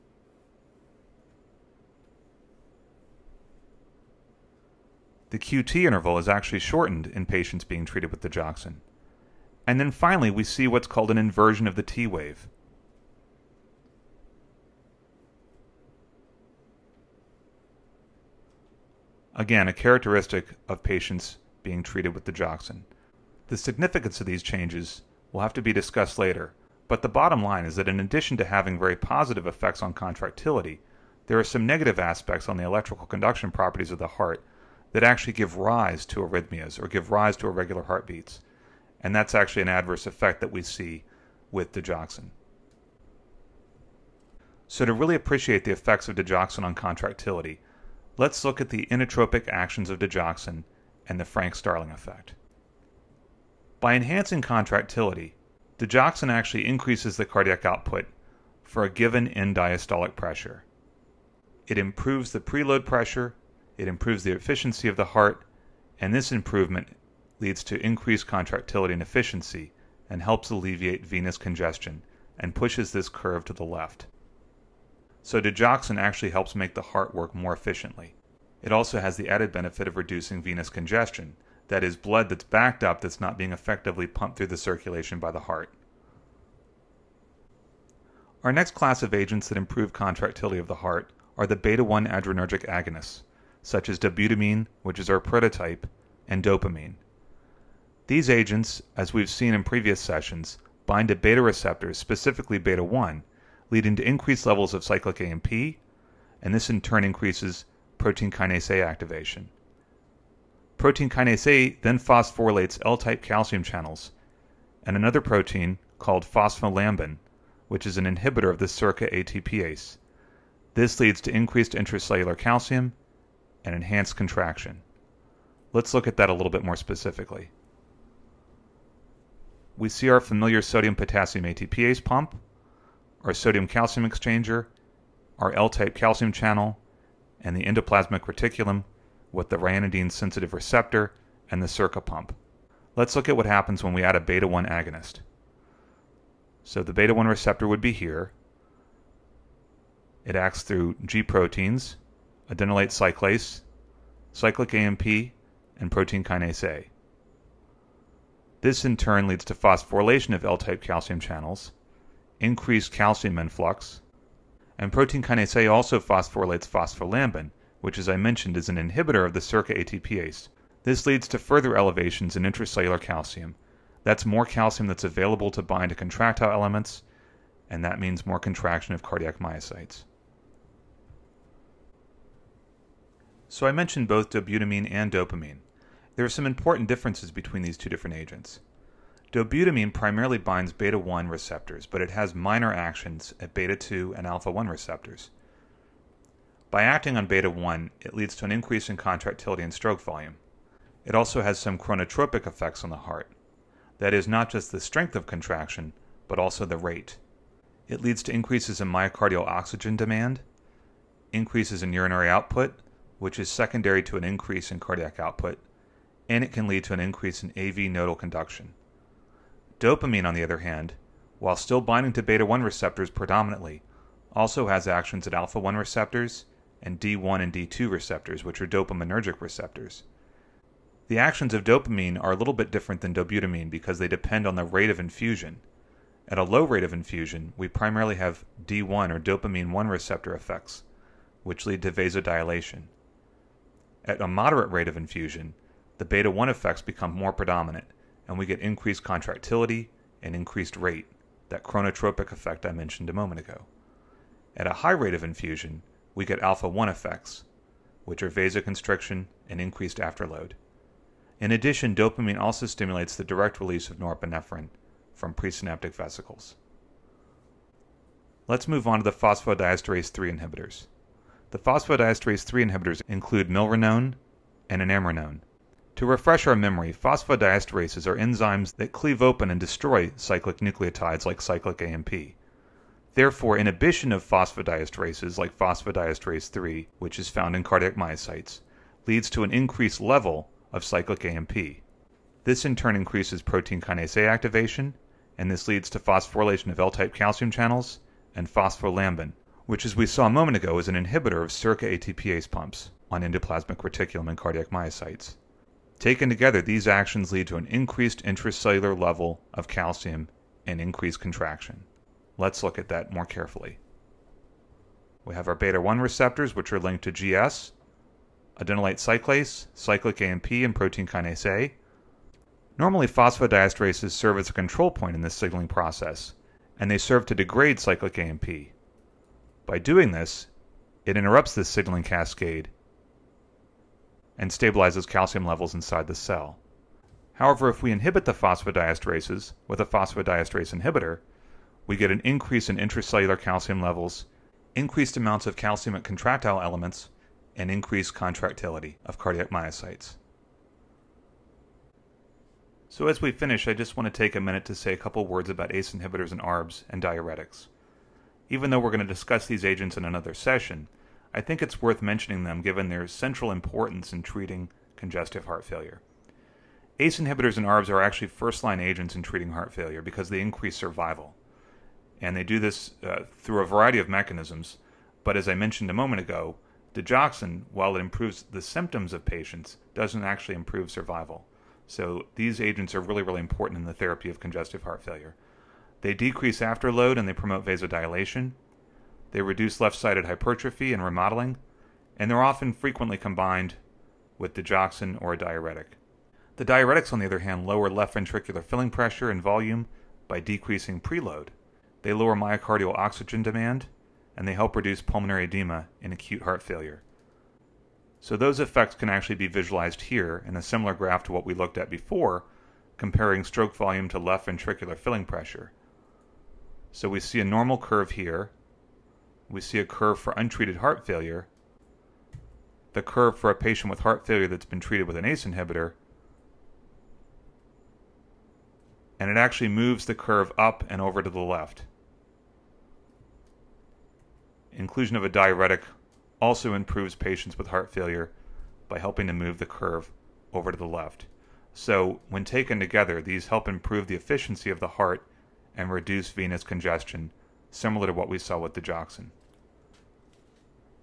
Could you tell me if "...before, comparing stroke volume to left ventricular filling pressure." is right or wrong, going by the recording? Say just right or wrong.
right.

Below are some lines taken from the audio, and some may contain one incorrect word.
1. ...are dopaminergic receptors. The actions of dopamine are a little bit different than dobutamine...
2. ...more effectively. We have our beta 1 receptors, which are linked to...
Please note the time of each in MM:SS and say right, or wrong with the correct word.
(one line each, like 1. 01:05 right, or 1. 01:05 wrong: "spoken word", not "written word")
1. 03:48 right
2. 05:13 wrong: "carefully", not "effectively".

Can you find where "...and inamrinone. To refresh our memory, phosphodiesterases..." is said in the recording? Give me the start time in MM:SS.
04:34.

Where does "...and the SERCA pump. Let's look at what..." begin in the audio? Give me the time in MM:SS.
02:21.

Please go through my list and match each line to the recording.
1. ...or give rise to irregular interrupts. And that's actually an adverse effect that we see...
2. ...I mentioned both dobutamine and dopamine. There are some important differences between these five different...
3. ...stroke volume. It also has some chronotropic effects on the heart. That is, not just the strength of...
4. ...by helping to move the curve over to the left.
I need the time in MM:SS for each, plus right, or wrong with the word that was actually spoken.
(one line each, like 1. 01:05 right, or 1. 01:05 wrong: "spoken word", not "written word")
1. 00:36 wrong: "heartbeats", not "interrupts"
2. 03:03 wrong: "two", not "five"
3. 03:19 right
4. 07:18 right.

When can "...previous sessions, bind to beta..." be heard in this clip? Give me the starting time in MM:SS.
01:39.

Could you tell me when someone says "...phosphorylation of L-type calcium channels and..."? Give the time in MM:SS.
04:55.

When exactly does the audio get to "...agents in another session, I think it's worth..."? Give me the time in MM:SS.
05:59.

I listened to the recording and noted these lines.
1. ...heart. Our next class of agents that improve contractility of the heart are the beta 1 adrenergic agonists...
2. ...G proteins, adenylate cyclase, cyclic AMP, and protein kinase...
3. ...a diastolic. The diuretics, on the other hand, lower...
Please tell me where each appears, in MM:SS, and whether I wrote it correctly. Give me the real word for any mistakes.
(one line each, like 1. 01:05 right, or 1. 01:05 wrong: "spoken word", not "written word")
1. 01:25 right
2. 02:31 right
3. 06:35 wrong: "diuretic", not "diastolic".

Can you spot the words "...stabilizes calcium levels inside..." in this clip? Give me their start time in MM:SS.
05:34.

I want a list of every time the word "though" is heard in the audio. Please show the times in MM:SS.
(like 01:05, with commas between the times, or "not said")
05:58.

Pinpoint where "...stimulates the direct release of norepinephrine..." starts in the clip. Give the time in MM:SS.
04:22.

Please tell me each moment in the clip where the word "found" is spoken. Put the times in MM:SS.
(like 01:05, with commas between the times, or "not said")
04:47.